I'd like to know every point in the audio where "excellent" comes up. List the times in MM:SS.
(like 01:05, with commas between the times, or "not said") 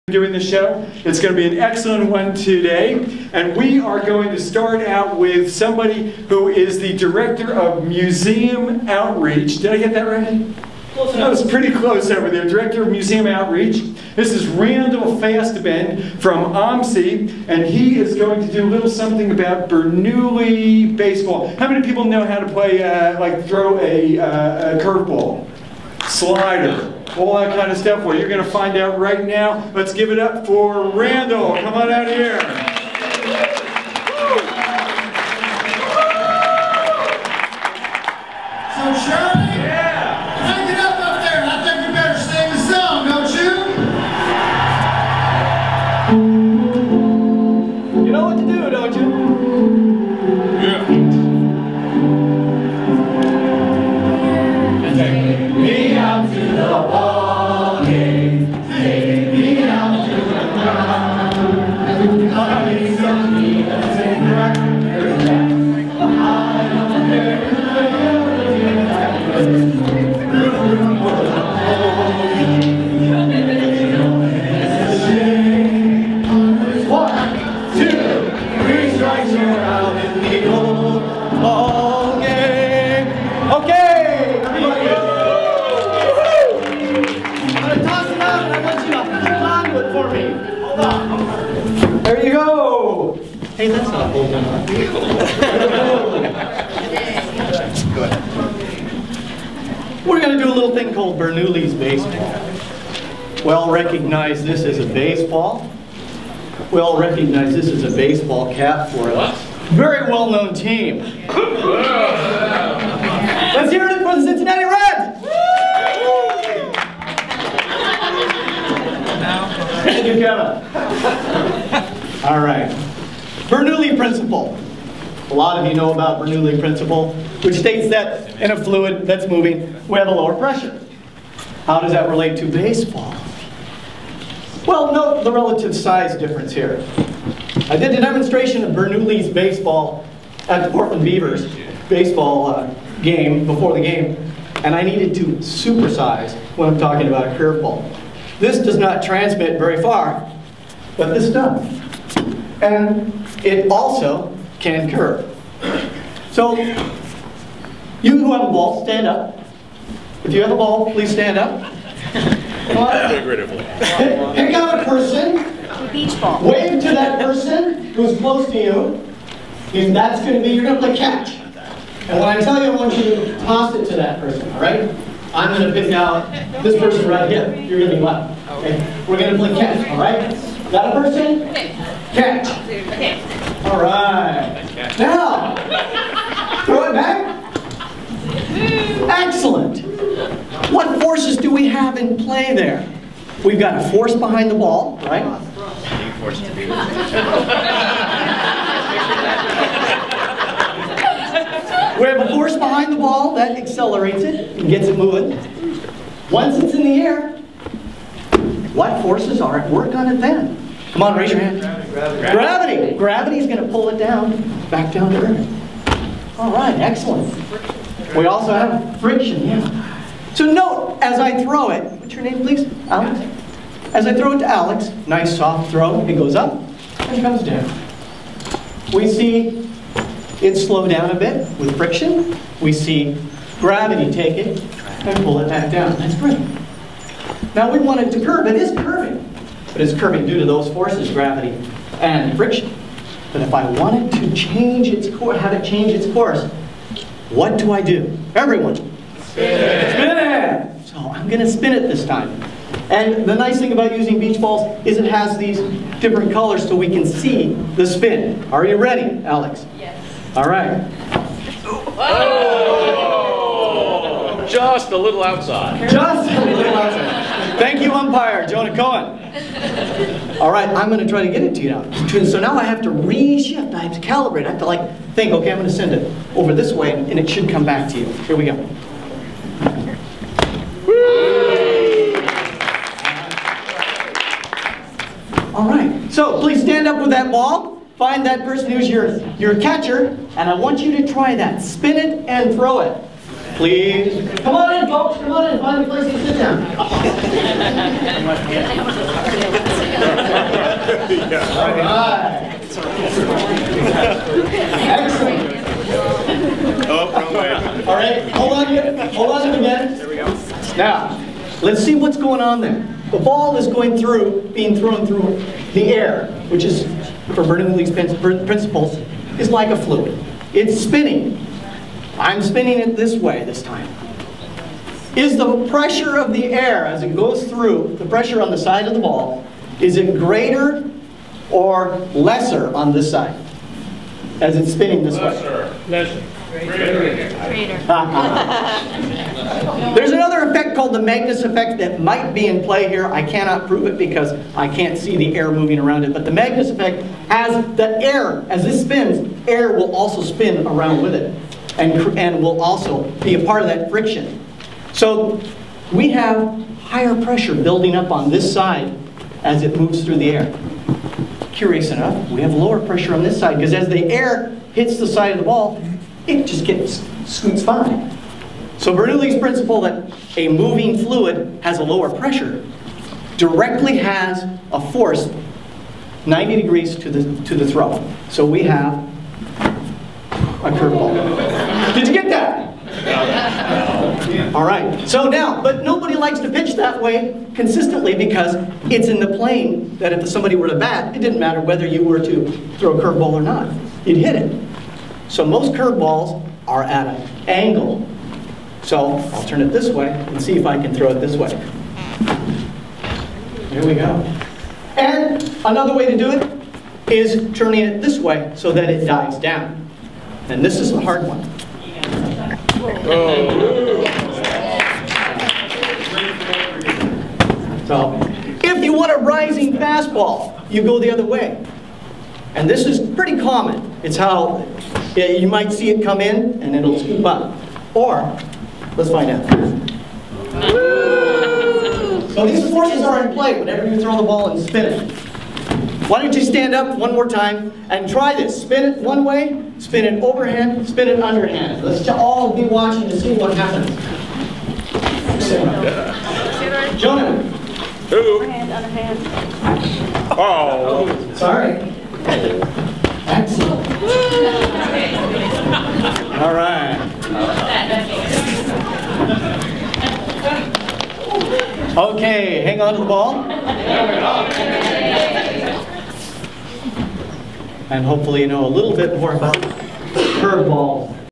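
00:01, 03:09, 03:36, 05:04, 07:33.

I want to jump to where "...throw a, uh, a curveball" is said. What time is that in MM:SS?
00:23.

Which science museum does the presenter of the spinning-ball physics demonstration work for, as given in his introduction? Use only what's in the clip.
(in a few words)
OMSI.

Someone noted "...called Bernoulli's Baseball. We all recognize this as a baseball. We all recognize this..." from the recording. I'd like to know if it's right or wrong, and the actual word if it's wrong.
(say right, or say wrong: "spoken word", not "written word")
right.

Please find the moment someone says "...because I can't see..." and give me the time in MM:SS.
05:43.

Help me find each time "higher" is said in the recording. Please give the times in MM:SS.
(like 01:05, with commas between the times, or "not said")
05:56.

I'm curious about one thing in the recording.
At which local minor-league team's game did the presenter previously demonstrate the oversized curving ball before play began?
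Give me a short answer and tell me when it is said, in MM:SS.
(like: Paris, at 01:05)
Portland Beavers, at 02:20.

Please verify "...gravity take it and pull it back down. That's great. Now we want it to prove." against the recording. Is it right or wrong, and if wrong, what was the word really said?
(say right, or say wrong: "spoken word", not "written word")
wrong: "curve", not "prove".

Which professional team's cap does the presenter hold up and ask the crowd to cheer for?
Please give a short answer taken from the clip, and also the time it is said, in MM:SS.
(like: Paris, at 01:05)
Cincinnati Reds, at 01:54.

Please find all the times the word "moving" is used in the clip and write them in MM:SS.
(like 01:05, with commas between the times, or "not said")
02:09, 03:24, 05:45, 06:10.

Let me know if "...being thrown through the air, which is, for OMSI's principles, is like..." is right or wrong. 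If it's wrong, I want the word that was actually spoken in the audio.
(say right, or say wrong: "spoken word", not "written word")
wrong: "Bernoulli", not "OMSI".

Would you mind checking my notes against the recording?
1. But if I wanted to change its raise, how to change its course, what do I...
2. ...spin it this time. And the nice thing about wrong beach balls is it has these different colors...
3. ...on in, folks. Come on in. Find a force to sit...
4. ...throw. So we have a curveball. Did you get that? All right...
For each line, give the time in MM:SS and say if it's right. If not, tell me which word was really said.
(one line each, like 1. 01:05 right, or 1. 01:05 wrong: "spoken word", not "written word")
1. 04:03 wrong: "course", not "raise"
2. 04:11 wrong: "using", not "wrong"
3. 04:54 wrong: "place", not "force"
4. 06:17 right.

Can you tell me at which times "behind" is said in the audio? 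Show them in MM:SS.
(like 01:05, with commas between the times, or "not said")
03:14, 03:22.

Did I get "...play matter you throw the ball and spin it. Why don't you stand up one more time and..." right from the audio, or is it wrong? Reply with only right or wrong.
wrong.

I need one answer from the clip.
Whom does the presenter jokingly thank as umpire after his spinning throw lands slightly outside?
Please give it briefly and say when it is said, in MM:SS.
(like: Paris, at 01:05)
Jonah Cohen, at 04:28.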